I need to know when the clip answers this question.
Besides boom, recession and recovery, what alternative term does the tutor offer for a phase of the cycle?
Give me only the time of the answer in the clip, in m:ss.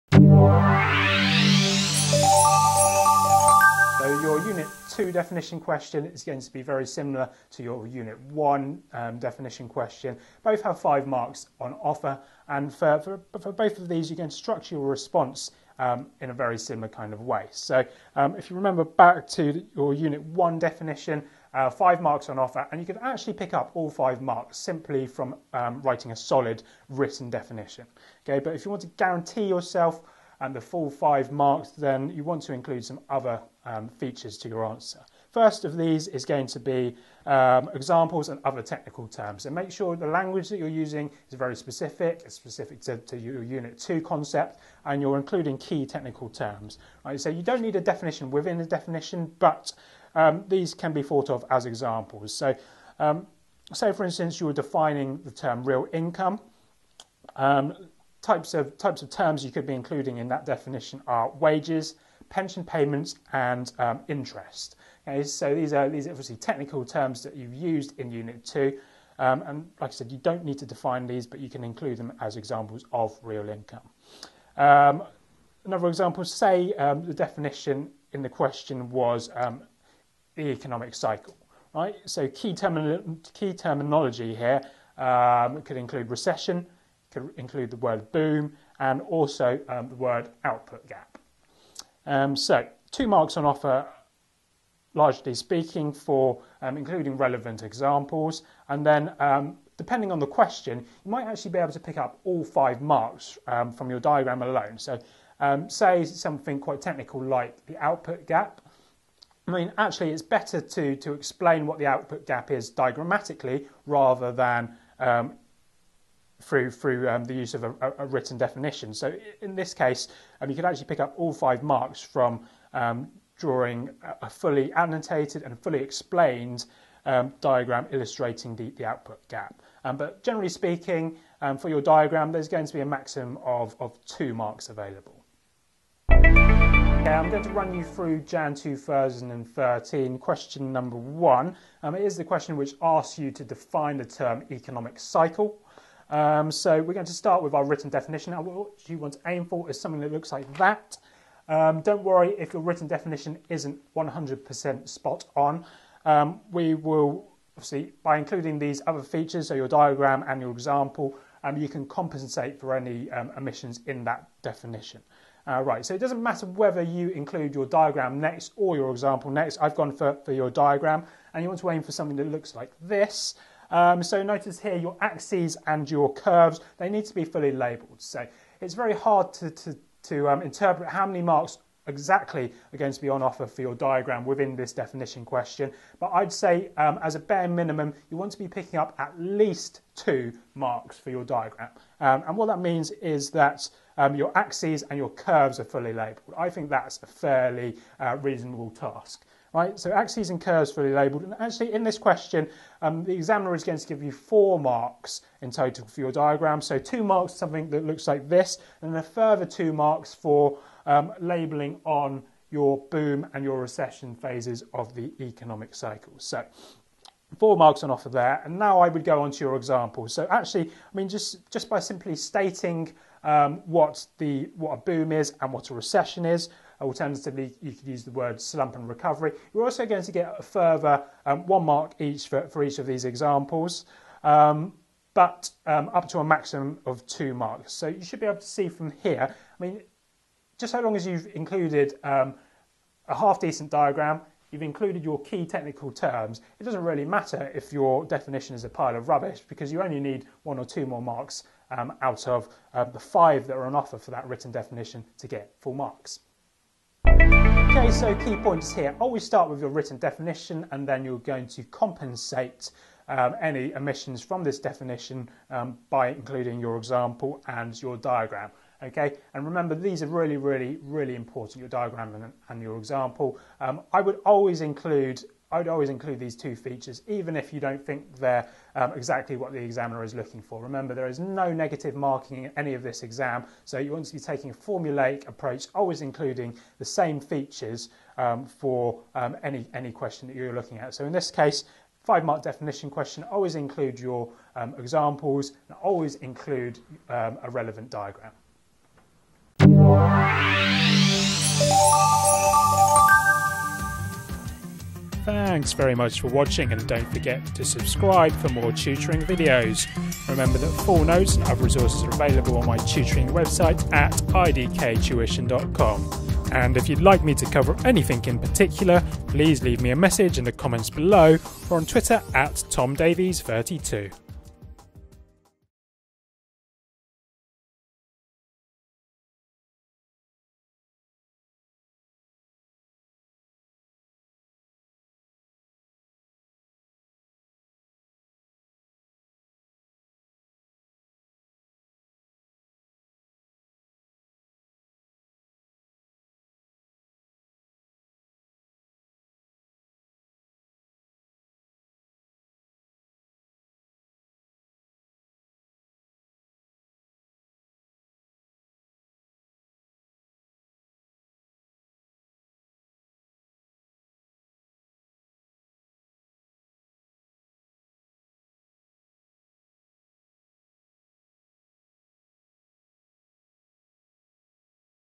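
3:48.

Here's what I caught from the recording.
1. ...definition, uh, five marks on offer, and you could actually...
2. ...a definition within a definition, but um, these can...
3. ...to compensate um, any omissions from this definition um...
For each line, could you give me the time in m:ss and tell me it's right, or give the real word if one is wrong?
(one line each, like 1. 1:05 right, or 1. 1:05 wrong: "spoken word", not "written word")
1. 0:20 right
2. 0:47 right
3. 4:21 right.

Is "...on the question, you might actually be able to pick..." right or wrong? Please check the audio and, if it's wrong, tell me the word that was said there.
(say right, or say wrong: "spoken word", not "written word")
right.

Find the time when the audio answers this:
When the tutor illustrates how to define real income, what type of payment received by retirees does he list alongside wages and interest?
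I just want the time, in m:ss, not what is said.
1:02.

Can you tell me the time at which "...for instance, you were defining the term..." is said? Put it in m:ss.
0:53.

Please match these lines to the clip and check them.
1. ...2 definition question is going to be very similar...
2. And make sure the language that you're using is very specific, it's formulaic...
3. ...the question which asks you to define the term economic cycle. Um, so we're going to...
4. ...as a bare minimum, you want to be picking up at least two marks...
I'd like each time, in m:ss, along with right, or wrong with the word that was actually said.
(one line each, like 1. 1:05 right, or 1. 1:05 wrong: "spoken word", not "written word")
1. 0:04 right
2. 0:39 wrong: "specific", not "formulaic"
3. 2:22 right
4. 3:07 right.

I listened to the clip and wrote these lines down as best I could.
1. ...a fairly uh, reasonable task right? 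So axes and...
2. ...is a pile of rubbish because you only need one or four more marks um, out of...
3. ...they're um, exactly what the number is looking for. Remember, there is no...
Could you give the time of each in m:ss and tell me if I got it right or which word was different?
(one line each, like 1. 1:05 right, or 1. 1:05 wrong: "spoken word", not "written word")
1. 3:17 right
2. 4:08 wrong: "two", not "four"
3. 4:38 wrong: "examiner", not "number".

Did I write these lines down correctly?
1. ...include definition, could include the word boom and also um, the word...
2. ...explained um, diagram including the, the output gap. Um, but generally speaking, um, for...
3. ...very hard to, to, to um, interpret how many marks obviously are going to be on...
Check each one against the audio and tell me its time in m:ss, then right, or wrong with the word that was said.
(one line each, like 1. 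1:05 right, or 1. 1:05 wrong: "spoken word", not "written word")
1. 1:25 wrong: "recession", not "definition"
2. 2:05 wrong: "illustrating", not "including"
3. 2:58 wrong: "exactly", not "obviously".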